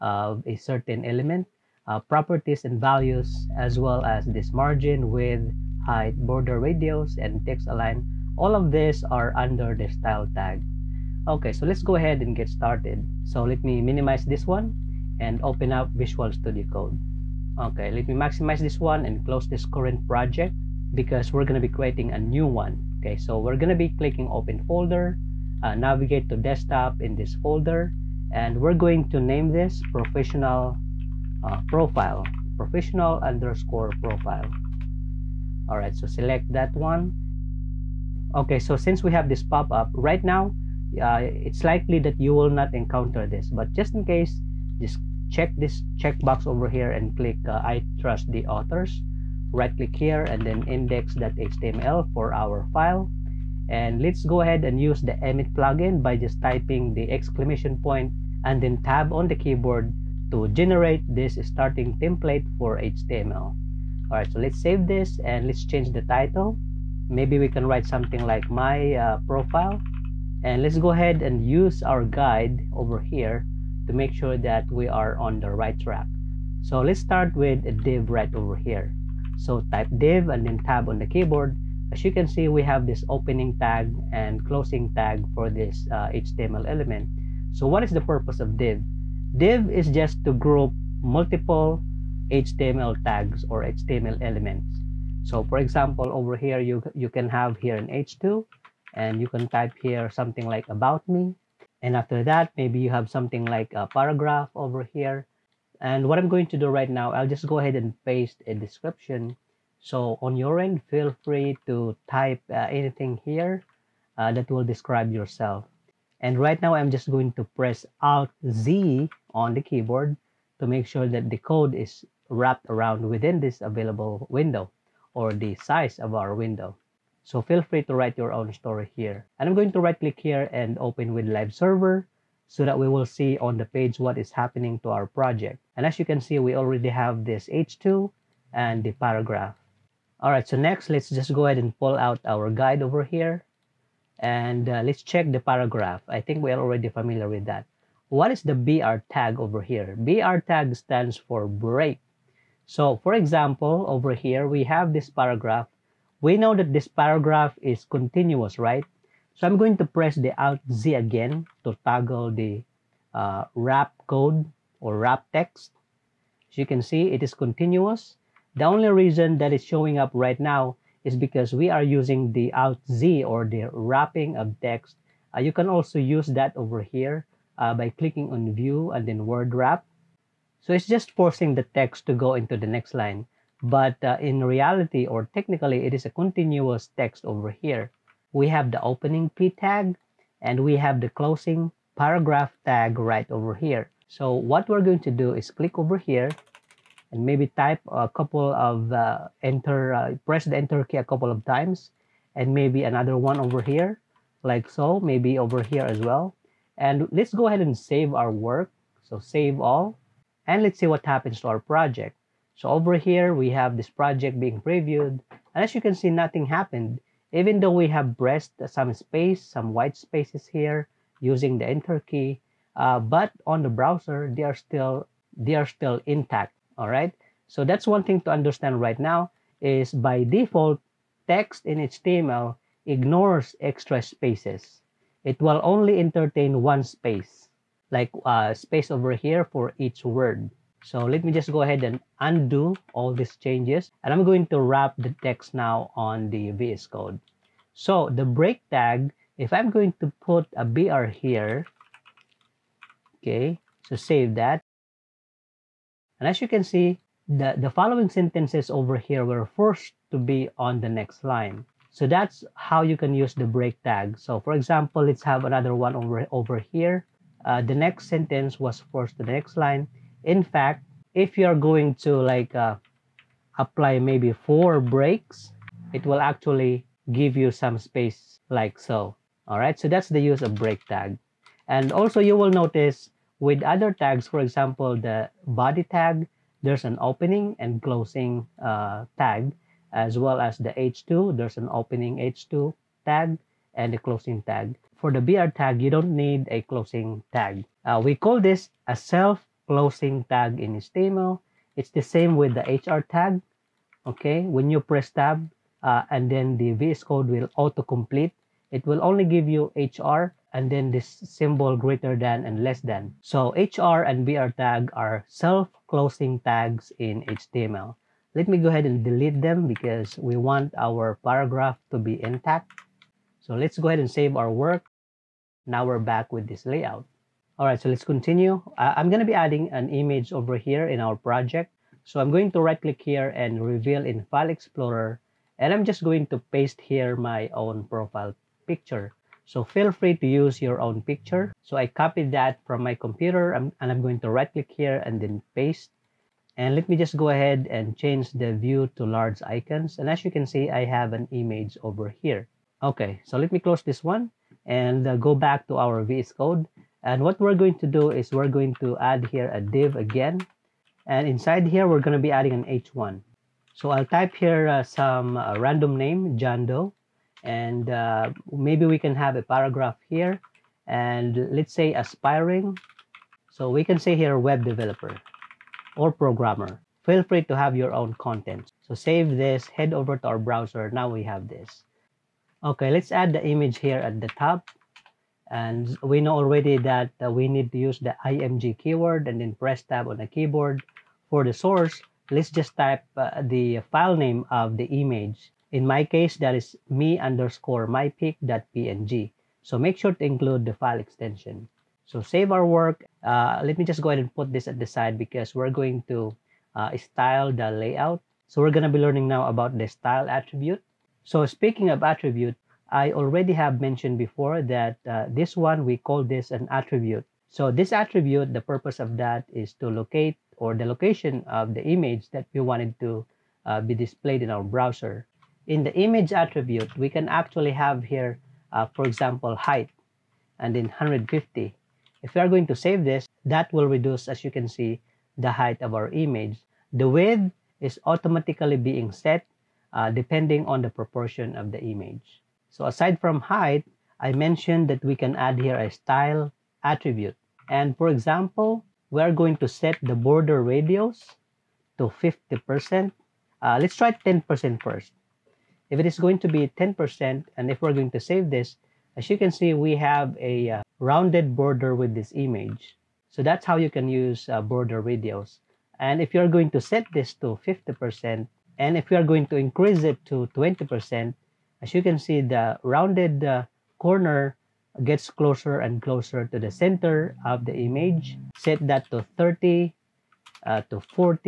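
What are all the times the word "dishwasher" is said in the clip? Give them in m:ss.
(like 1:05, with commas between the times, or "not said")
not said.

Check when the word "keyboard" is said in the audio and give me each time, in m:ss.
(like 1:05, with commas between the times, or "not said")
0:59, 1:21, 1:59, 6:30.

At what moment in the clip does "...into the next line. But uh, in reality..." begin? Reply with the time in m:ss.
3:02.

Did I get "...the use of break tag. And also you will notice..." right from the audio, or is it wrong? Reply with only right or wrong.
right.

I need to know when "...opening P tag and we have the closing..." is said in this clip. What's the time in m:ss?
3:08.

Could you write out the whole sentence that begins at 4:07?
So the break tag, if I'm going to put a BR here, okay, so save that.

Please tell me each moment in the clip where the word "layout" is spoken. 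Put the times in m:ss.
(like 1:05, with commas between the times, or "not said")
5:26, 6:47.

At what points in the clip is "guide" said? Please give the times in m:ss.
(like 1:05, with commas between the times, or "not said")
1:12, 2:22.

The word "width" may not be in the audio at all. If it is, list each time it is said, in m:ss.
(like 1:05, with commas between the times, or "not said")
0:05, 7:17.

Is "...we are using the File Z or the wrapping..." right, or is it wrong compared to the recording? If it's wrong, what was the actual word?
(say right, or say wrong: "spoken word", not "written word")
wrong: "Alt", not "File".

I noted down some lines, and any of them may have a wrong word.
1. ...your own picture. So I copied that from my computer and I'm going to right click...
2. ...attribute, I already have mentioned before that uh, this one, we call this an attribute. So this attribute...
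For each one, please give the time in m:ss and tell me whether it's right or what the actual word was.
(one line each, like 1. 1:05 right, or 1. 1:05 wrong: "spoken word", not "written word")
1. 5:40 right
2. 6:52 right.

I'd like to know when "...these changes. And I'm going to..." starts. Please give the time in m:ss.
4:03.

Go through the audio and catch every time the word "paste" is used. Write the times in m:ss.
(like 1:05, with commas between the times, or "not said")
1:48, 5:36, 5:45.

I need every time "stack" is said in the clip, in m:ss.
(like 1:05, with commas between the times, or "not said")
not said.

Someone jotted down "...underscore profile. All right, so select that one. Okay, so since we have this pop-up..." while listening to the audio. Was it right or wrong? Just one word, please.
right.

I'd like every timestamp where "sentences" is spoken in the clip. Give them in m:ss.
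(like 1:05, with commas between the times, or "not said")
4:18, 4:28.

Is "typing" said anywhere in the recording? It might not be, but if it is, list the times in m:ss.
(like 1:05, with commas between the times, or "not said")
0:56.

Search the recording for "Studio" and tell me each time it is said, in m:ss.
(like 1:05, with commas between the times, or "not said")
0:16.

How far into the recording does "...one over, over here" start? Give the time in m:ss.
4:25.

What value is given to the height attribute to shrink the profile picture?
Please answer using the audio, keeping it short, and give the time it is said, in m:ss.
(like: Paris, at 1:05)
150, at 7:10.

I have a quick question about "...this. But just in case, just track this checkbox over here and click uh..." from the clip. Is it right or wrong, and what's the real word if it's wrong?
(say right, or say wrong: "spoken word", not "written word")
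wrong: "check", not "track".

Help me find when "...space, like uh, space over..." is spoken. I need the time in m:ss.
3:56.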